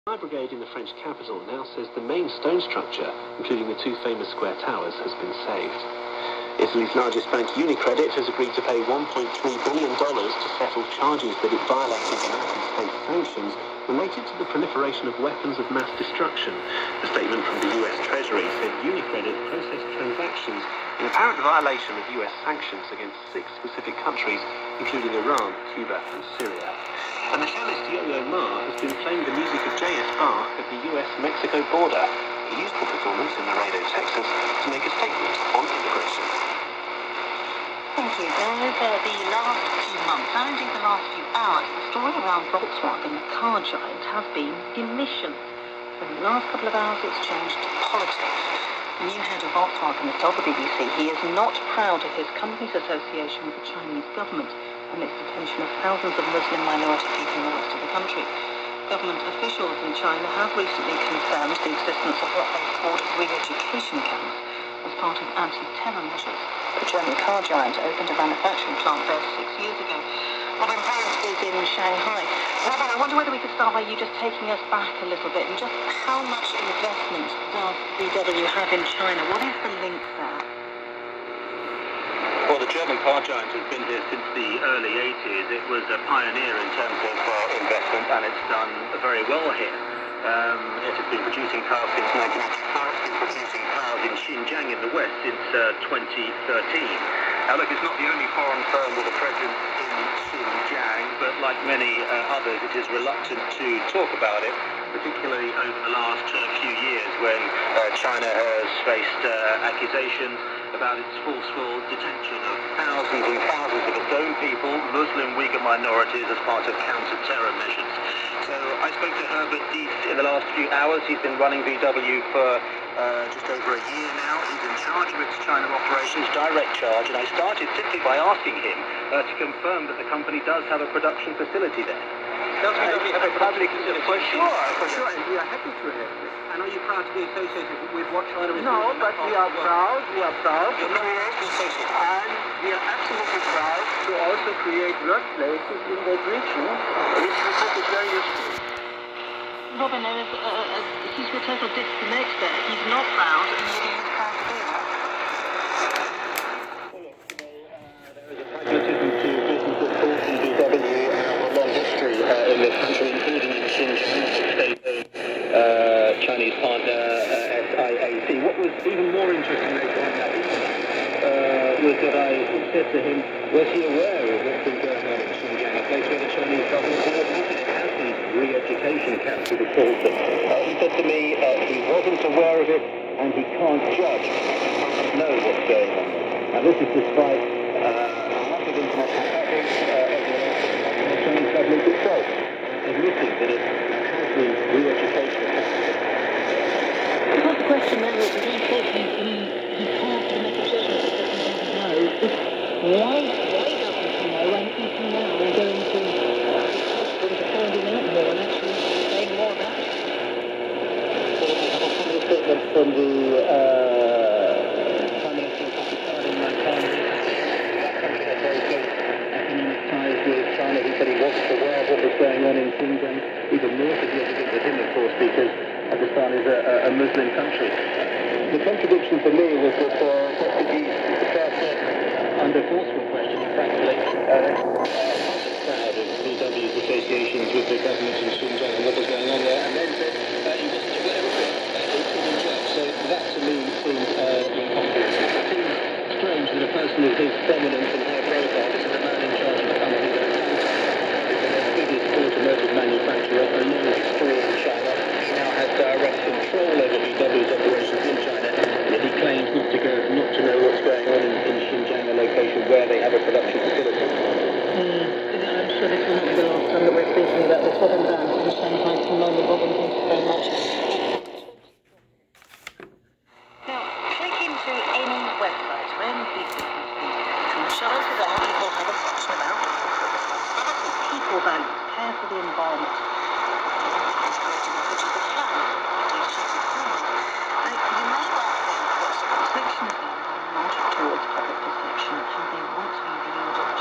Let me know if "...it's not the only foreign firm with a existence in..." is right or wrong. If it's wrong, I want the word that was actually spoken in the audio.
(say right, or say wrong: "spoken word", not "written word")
wrong: "presence", not "existence".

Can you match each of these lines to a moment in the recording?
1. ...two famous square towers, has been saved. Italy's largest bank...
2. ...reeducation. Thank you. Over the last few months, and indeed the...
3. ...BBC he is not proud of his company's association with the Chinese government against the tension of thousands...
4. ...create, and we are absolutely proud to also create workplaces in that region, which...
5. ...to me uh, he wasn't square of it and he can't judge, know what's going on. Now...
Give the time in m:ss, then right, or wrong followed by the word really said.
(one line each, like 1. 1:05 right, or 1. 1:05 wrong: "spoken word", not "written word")
1. 0:03 right
2. 0:35 wrong: "immigration", not "reeducation"
3. 0:50 wrong: "amidst", not "against"
4. 2:20 right
5. 3:00 wrong: "aware", not "square".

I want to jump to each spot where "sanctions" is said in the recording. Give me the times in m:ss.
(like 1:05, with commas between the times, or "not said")
0:13, 0:22.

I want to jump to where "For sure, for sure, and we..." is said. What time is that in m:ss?
2:14.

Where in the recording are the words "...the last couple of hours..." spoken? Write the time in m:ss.
0:46.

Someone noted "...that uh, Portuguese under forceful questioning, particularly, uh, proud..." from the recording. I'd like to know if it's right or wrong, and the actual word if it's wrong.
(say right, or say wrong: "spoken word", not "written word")
wrong: "frankly", not "particularly".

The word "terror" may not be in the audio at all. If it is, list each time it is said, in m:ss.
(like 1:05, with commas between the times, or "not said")
1:05, 1:56.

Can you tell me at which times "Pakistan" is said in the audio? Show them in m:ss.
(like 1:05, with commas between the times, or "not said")
3:45.